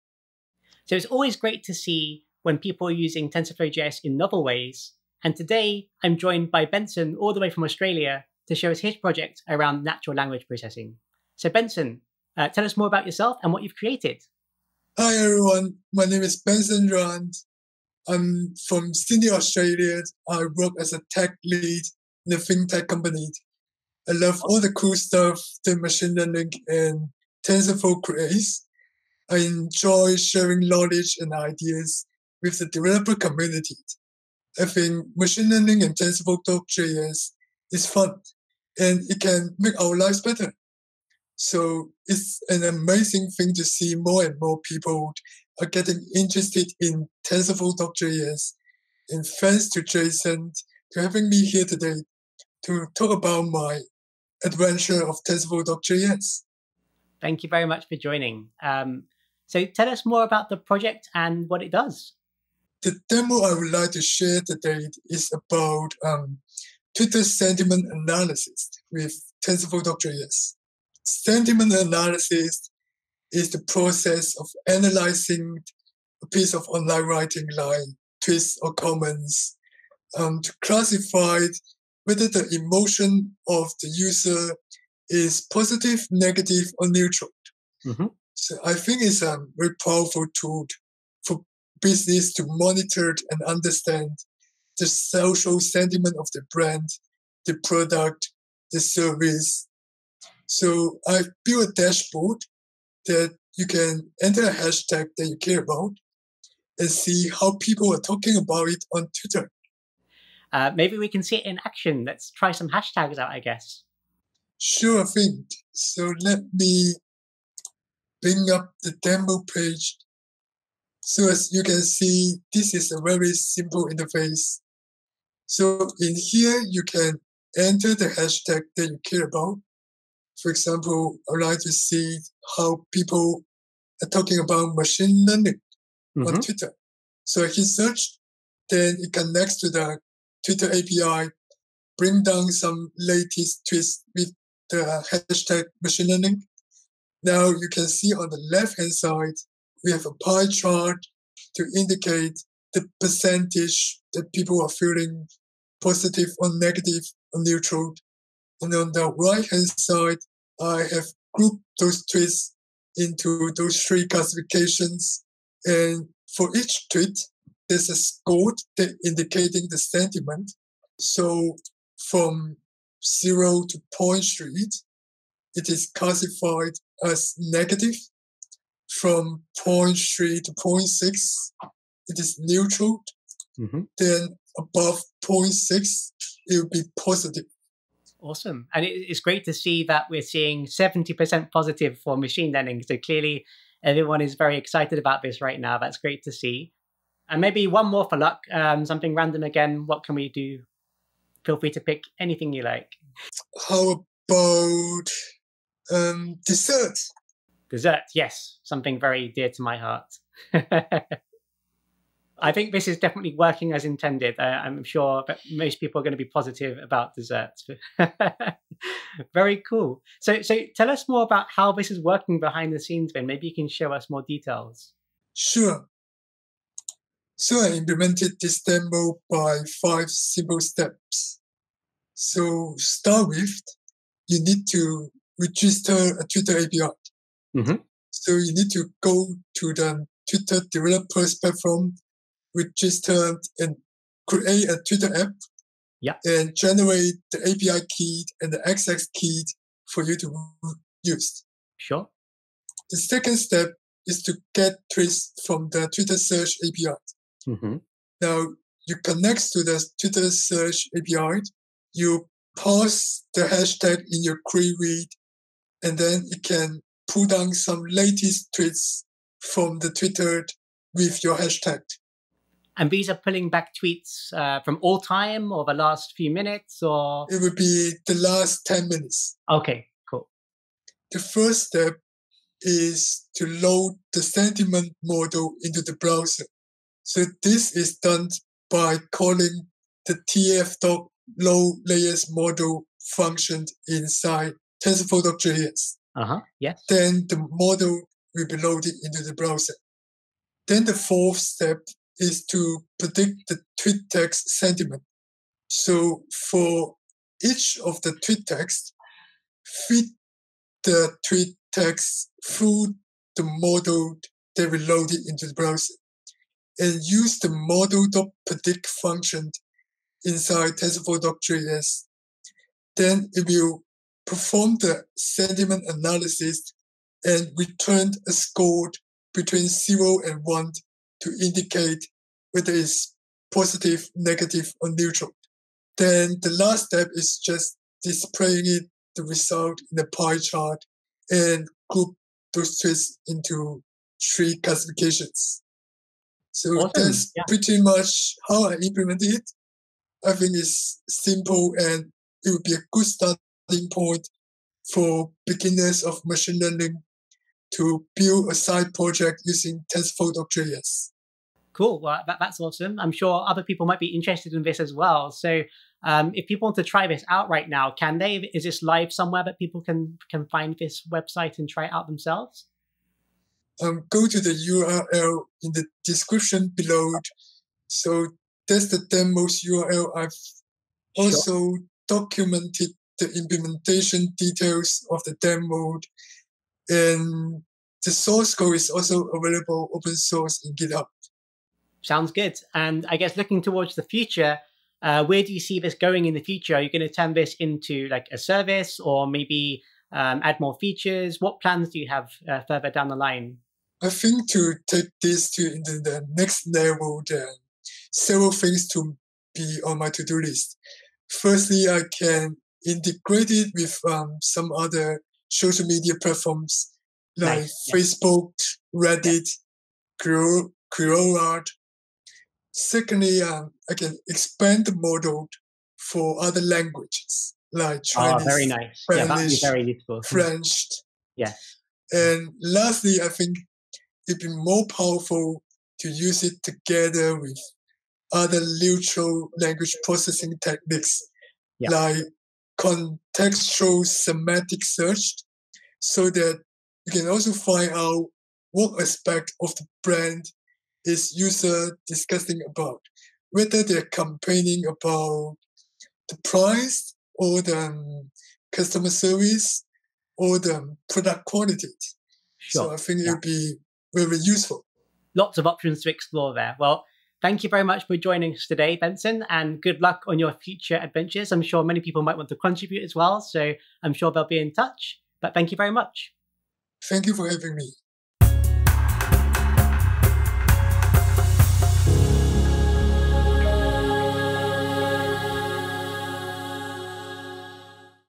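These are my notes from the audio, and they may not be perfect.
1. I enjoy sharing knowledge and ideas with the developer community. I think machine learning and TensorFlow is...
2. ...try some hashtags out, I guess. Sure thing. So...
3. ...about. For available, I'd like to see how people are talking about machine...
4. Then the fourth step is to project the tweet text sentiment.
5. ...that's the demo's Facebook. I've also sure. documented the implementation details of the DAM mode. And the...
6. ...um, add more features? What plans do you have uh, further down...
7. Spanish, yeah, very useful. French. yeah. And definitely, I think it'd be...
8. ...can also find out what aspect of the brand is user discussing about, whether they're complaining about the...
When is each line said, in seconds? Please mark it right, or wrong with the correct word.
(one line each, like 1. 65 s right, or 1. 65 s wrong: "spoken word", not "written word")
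1. 29 s right
2. 112 s right
3. 129 s wrong: "example", not "available"
4. 300 s wrong: "predict", not "project"
5. 378 s wrong: "URL", not "Facebook"
6. 400 s right
7. 429 s wrong: "lastly", not "definitely"
8. 447 s right.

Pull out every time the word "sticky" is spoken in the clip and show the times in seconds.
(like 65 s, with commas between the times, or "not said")
not said.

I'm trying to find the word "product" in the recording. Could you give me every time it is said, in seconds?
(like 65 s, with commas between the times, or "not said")
97 s, 461 s.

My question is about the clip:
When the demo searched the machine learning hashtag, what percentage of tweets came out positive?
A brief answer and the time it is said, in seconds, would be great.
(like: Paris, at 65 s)
70%, at 190 s.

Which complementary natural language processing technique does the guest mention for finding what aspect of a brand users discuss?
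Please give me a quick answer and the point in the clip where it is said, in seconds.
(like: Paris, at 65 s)
contextual semantic search, at 442 s.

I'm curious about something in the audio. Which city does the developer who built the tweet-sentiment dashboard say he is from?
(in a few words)
Sydney.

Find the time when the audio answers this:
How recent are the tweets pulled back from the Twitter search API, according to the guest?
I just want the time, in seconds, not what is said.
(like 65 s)
278 s.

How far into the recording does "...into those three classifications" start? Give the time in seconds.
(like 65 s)
162 s.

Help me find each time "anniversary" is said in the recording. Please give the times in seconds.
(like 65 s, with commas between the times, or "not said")
not said.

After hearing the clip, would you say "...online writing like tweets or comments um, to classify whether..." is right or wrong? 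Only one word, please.
right.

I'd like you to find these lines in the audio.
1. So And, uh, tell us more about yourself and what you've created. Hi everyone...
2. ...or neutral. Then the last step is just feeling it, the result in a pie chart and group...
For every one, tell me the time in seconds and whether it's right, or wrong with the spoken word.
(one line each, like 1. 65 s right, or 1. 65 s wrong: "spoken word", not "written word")
1. 11 s wrong: "Benson", not "And"
2. 334 s wrong: "displaying", not "feeling".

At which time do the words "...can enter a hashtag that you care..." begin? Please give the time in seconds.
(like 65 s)
103 s.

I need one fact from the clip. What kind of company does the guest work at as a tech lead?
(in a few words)
fintech company.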